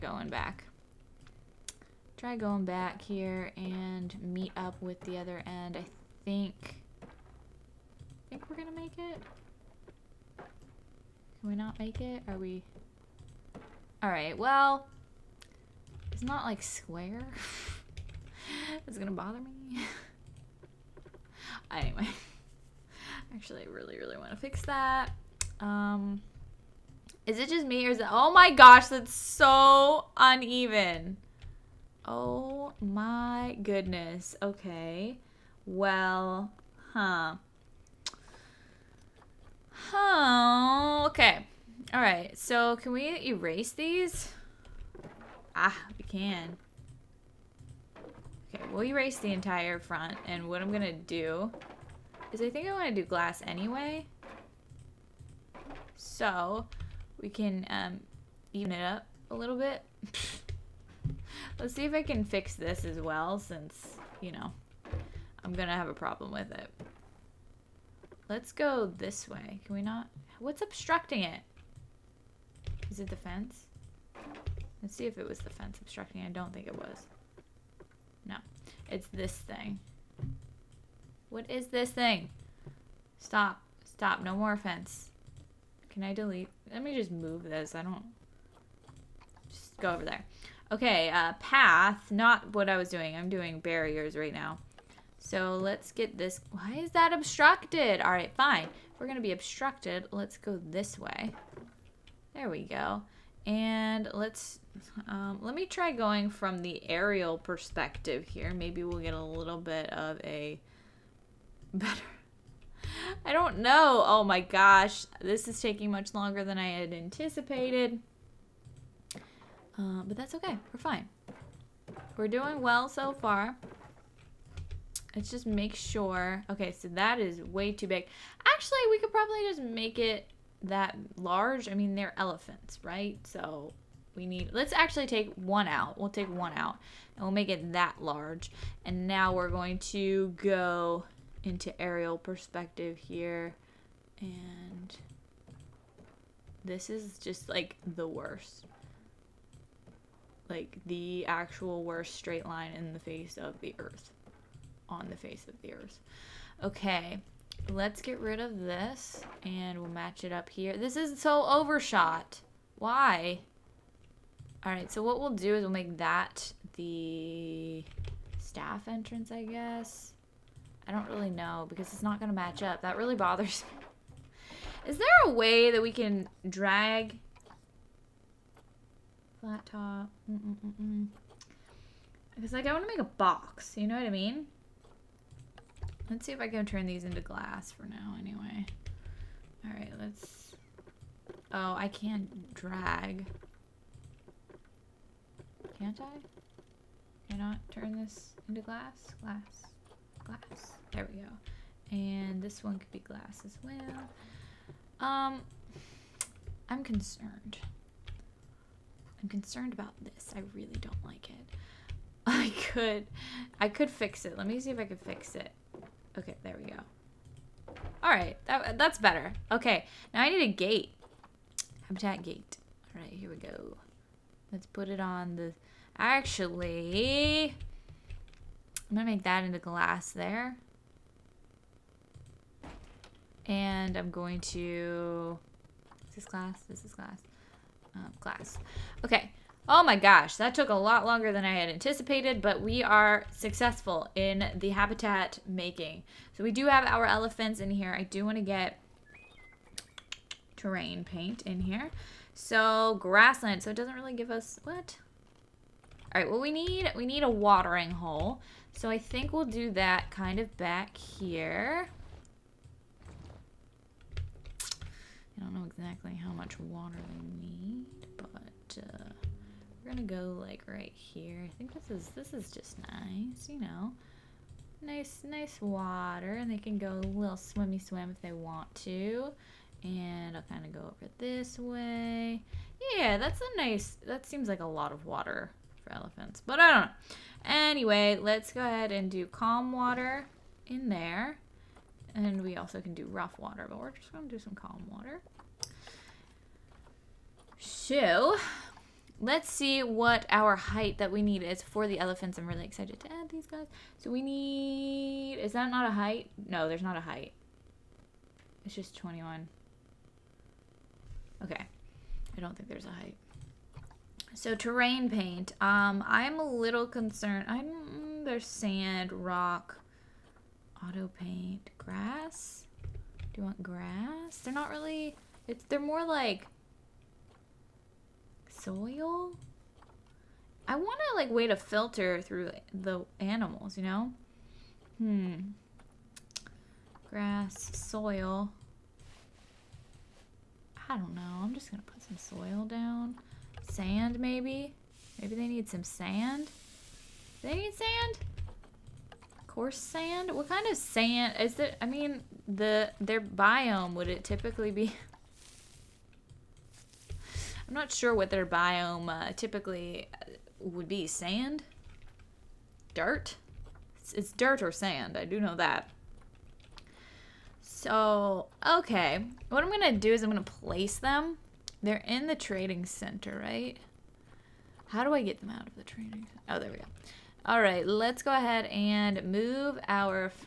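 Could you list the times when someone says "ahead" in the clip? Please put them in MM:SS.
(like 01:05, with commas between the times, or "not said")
04:48, 06:18.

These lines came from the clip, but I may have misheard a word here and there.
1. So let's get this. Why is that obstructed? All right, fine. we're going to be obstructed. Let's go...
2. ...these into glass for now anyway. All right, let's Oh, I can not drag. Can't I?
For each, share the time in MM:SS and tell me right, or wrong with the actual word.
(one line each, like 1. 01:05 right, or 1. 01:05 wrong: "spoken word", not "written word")
1. 01:35 right
2. 03:06 right.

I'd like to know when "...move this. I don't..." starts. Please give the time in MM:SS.
01:27.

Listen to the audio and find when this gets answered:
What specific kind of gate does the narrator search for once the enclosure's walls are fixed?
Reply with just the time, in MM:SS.
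03:41.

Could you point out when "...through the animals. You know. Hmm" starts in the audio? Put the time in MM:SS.
05:32.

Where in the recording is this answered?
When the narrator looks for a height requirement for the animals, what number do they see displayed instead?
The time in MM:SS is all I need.
05:08.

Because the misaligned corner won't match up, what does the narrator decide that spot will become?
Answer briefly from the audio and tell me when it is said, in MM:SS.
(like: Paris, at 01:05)
staff entrance, at 02:48.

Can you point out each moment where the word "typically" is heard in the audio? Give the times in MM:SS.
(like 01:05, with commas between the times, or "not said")
05:54, 05:59.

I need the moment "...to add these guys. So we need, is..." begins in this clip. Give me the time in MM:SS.
05:02.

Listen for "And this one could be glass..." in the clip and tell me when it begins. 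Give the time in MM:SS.
03:21.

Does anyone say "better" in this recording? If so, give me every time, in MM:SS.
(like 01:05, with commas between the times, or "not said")
01:51, 03:38.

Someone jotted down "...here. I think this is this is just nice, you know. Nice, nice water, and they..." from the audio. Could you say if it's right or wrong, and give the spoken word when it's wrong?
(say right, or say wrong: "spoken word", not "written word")
right.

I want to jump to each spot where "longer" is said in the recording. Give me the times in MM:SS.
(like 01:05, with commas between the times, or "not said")
01:56, 04:01.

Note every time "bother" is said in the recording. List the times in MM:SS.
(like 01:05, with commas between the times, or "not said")
00:19, 02:53.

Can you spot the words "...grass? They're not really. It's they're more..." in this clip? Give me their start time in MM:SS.
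05:23.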